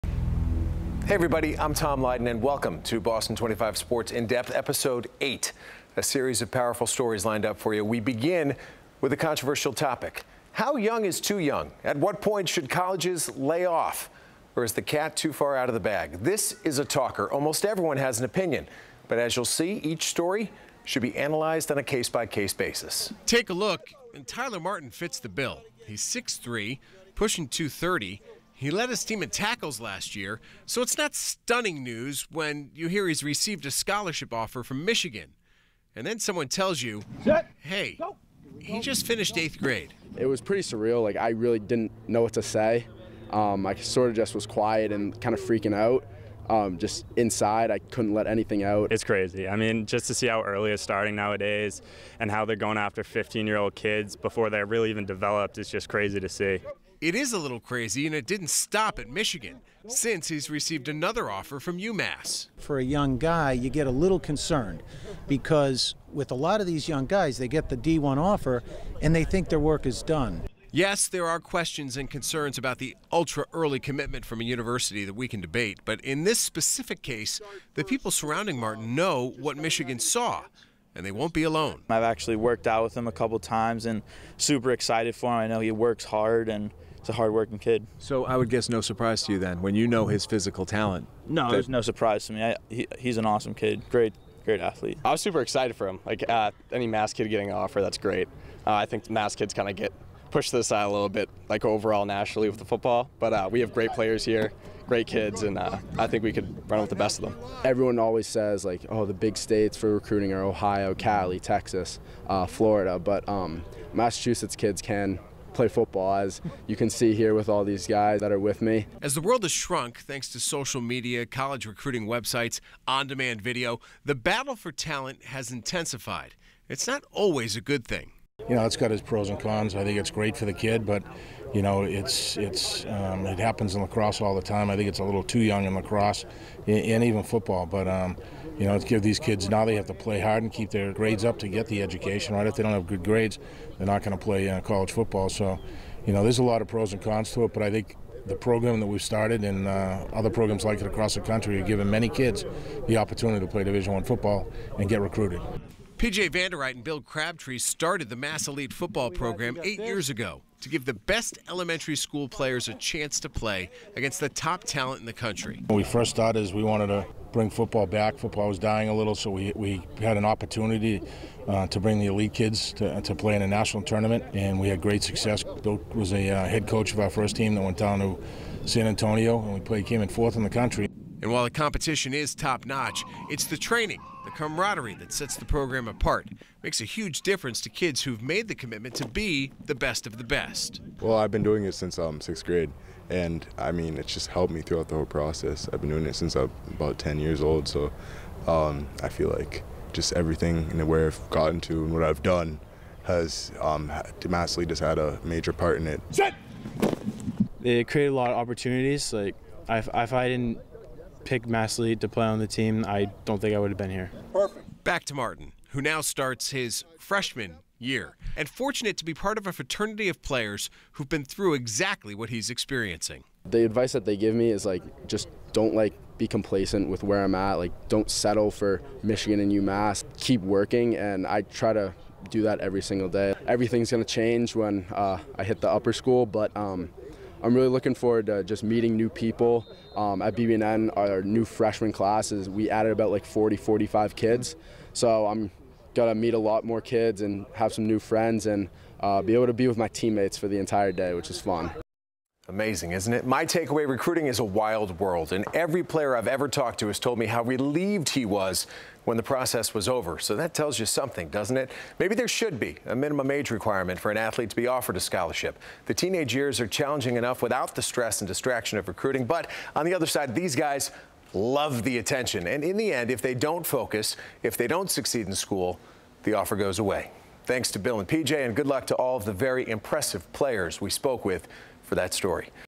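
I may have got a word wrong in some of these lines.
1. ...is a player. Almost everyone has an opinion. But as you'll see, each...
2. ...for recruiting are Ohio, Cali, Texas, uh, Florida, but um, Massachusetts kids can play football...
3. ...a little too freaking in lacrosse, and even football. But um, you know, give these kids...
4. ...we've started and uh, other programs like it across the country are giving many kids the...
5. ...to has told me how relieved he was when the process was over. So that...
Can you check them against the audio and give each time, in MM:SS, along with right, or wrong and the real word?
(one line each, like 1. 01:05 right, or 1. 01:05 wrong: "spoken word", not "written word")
1. 00:16 wrong: "talker", not "player"
2. 01:49 right
3. 02:14 wrong: "young", not "freaking"
4. 02:28 right
5. 04:16 right.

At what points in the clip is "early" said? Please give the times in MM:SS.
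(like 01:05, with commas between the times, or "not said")
00:50, 01:13.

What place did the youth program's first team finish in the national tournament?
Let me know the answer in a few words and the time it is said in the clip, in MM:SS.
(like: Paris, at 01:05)
4th, at 03:00.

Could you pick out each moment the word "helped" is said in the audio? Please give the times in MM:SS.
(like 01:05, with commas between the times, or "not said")
03:14.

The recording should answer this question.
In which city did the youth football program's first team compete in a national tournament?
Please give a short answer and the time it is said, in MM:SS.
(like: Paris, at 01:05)
San Antonio, at 02:58.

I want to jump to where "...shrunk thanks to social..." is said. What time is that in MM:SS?
01:59.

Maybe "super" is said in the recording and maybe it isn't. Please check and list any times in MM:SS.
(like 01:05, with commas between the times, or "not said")
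01:24, 01:35.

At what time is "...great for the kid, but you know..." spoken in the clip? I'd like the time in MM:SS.
02:10.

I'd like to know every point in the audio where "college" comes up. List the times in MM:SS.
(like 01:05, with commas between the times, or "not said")
00:12, 02:01, 02:24.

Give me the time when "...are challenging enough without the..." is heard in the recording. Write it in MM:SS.
04:26.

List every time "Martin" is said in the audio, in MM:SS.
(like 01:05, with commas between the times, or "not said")
00:24, 01:18, 03:35.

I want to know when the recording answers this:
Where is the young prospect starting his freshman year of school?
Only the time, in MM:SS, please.
04:00.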